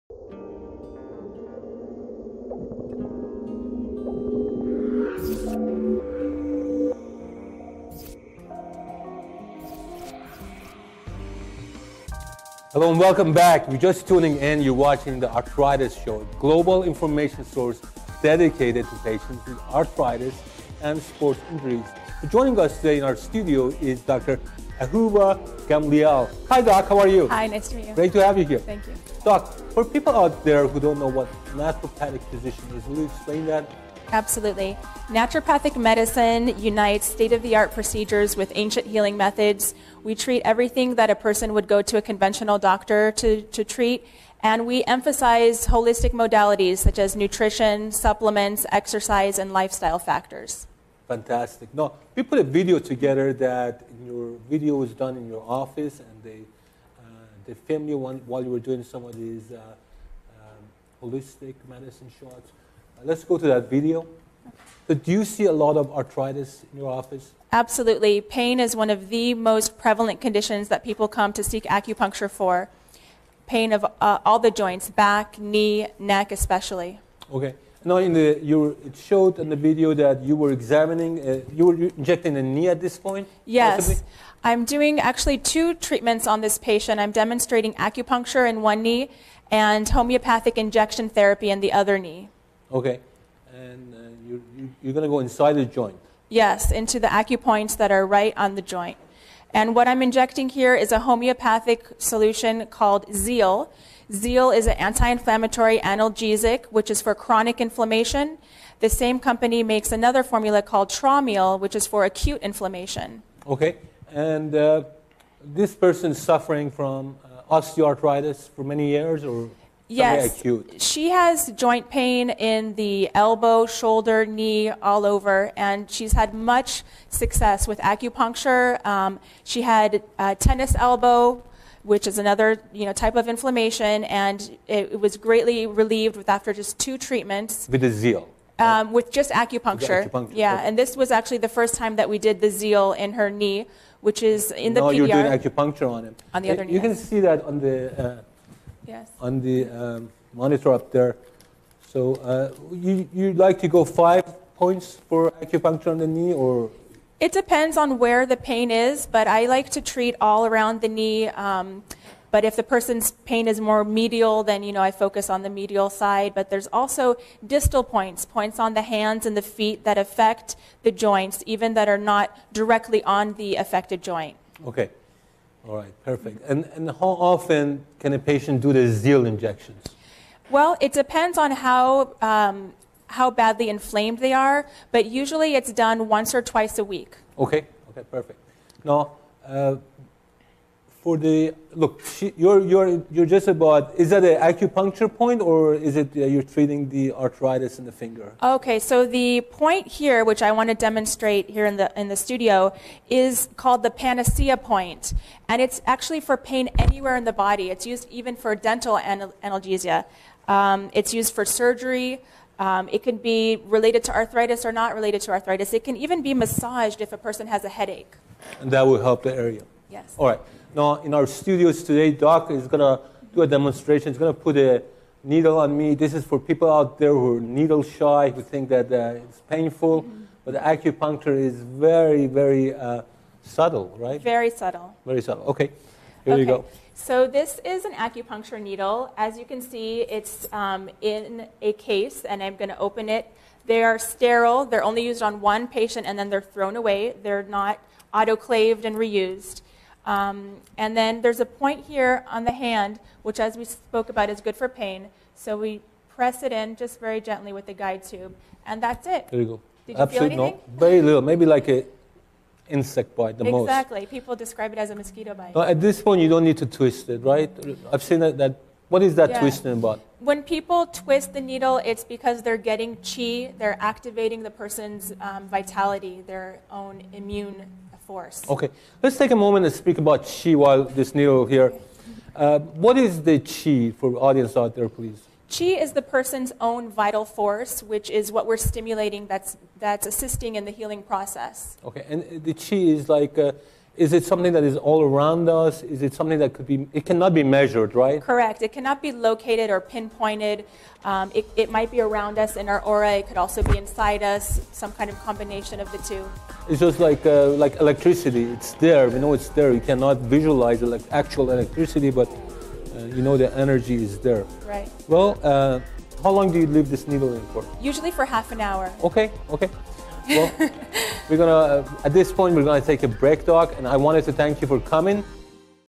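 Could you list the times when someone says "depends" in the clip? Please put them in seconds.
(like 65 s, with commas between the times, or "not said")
157 s, 180 s.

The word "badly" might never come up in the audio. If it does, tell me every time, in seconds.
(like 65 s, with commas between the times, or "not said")
183 s.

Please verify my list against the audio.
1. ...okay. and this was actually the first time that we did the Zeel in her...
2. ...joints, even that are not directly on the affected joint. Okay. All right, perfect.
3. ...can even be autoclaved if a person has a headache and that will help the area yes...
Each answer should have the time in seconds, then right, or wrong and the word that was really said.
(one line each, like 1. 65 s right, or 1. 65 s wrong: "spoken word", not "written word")
1. 140 s right
2. 170 s right
3. 215 s wrong: "massaged", not "autoclaved".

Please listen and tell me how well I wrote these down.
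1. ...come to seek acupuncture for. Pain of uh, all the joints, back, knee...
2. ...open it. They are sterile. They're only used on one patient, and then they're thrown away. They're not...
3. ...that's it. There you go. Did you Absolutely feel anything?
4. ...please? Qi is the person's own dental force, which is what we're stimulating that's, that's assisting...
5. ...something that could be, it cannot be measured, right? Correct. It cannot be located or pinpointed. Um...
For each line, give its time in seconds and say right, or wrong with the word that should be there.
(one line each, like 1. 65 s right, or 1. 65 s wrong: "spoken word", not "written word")
1. 71 s right
2. 242 s right
3. 258 s right
4. 284 s wrong: "vital", not "dental"
5. 296 s right.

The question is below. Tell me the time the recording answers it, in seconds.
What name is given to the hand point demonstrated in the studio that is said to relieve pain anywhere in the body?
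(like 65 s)
203 s.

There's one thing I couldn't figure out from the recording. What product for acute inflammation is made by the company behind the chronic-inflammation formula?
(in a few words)
Traumeel.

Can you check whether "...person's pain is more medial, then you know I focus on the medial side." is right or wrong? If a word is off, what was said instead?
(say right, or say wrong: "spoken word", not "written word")
right.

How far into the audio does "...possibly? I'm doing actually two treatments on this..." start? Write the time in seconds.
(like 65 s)
83 s.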